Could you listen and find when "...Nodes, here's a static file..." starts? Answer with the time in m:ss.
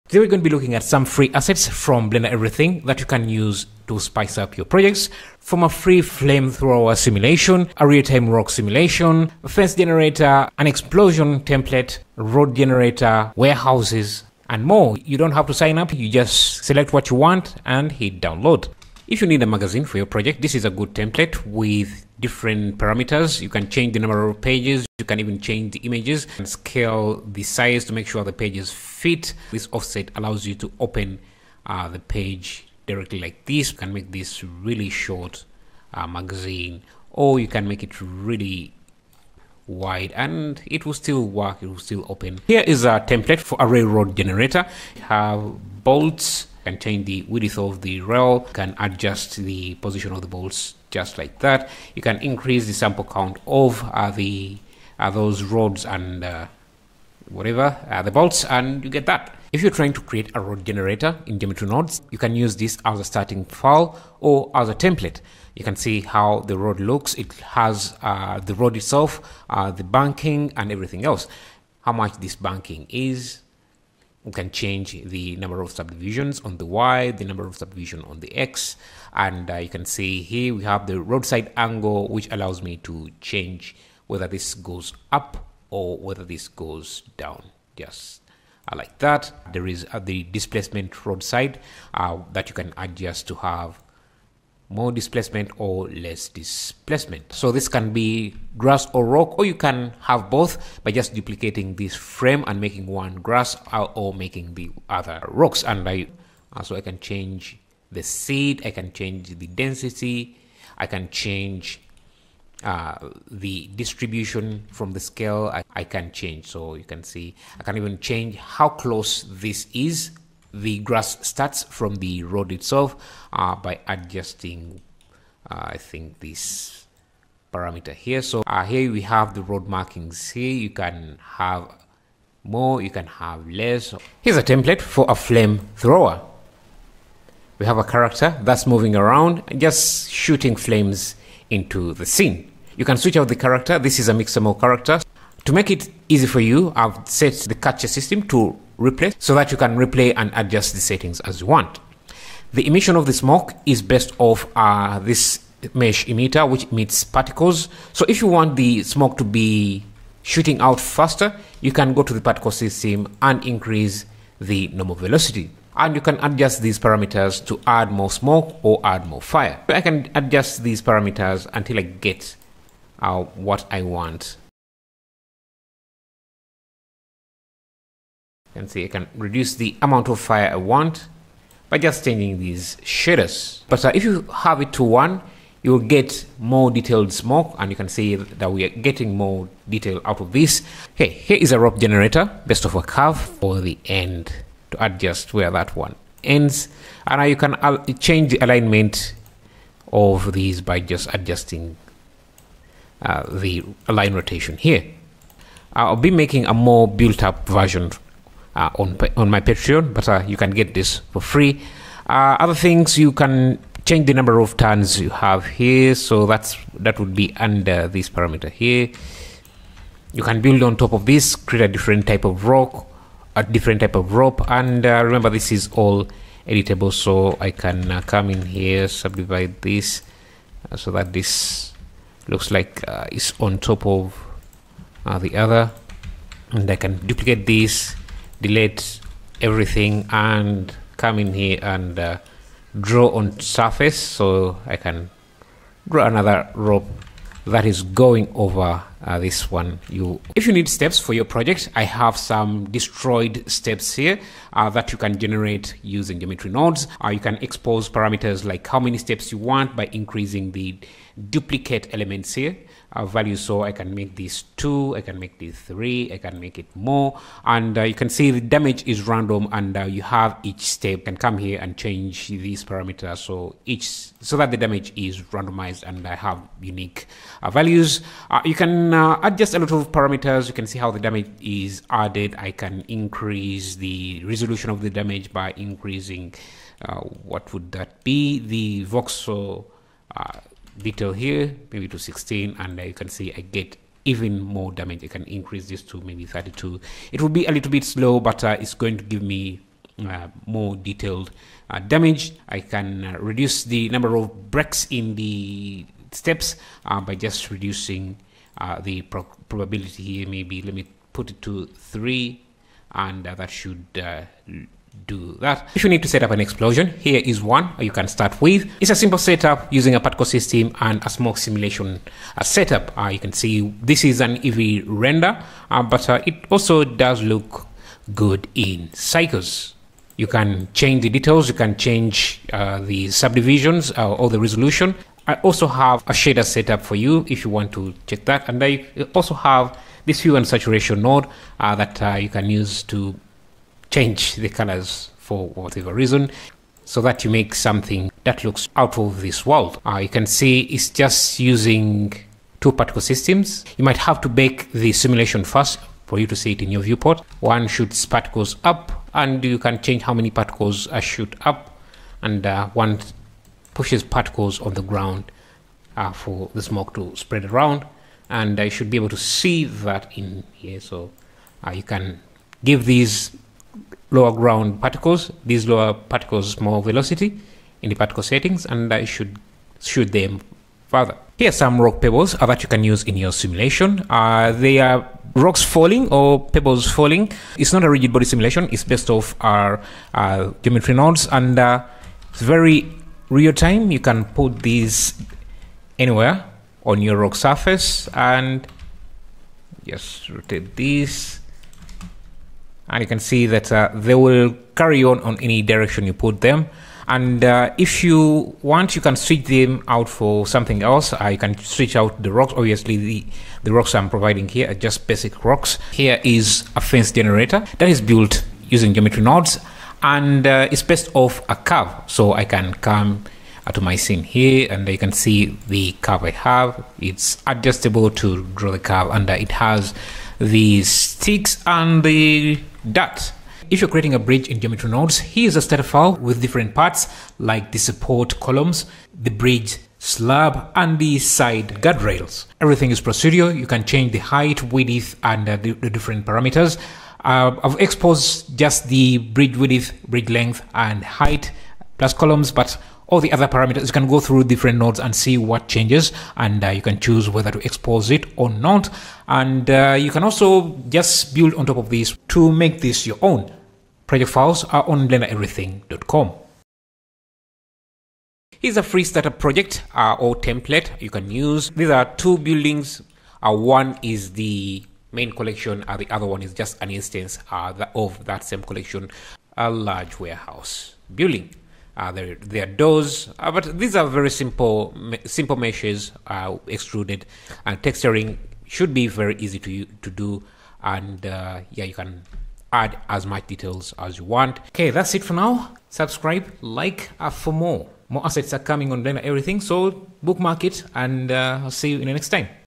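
7:14.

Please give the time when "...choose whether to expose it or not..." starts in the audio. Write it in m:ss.
7:36.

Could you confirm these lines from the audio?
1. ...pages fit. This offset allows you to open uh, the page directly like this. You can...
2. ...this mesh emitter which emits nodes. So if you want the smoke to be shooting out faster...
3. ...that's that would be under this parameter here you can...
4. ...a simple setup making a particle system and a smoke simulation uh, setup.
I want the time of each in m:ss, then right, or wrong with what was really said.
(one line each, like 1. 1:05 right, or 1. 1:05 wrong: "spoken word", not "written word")
1. 0:28 right
2. 2:34 wrong: "particles", not "nodes"
3. 3:36 right
4. 5:18 wrong: "using", not "making".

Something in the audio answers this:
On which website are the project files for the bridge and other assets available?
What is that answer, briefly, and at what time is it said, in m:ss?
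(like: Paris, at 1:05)
blendereverything.com, at 7:45.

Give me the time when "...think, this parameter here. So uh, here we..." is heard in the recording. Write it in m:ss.
2:05.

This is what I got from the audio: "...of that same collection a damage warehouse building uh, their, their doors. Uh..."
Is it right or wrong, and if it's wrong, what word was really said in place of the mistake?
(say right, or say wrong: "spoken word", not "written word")
wrong: "large", not "damage".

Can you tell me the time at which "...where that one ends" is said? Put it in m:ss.
3:15.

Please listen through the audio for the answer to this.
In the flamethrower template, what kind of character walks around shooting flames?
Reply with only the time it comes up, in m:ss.
2:24.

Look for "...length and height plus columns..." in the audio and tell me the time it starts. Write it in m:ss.
7:30.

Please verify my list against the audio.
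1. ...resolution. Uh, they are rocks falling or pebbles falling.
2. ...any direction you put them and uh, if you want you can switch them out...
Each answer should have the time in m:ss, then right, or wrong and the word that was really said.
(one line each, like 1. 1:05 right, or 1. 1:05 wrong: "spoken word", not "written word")
1. 6:23 wrong: "simulation", not "resolution"
2. 6:45 right.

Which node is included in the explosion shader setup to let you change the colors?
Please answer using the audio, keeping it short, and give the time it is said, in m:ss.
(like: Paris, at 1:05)
hue and saturation, at 5:40.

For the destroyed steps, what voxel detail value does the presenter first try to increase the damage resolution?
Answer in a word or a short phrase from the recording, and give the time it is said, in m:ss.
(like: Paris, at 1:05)
16, at 4:51.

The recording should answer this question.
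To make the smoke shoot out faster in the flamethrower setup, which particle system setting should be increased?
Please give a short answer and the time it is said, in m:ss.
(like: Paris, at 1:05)
normal velocity, at 2:44.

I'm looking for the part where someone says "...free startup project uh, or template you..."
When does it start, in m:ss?
7:48.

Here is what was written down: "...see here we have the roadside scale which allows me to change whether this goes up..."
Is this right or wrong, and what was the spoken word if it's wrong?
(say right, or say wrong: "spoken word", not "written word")
wrong: "angle", not "scale".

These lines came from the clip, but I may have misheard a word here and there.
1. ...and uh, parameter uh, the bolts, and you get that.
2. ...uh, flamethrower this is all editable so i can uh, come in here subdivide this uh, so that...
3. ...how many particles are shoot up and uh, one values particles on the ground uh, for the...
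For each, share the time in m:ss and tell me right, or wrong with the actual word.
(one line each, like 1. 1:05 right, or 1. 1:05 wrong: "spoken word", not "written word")
1. 0:55 wrong: "whatever", not "parameter"
2. 3:44 wrong: "remember", not "flamethrower"
3. 6:00 wrong: "pushes", not "values".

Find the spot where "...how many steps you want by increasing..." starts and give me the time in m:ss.
4:18.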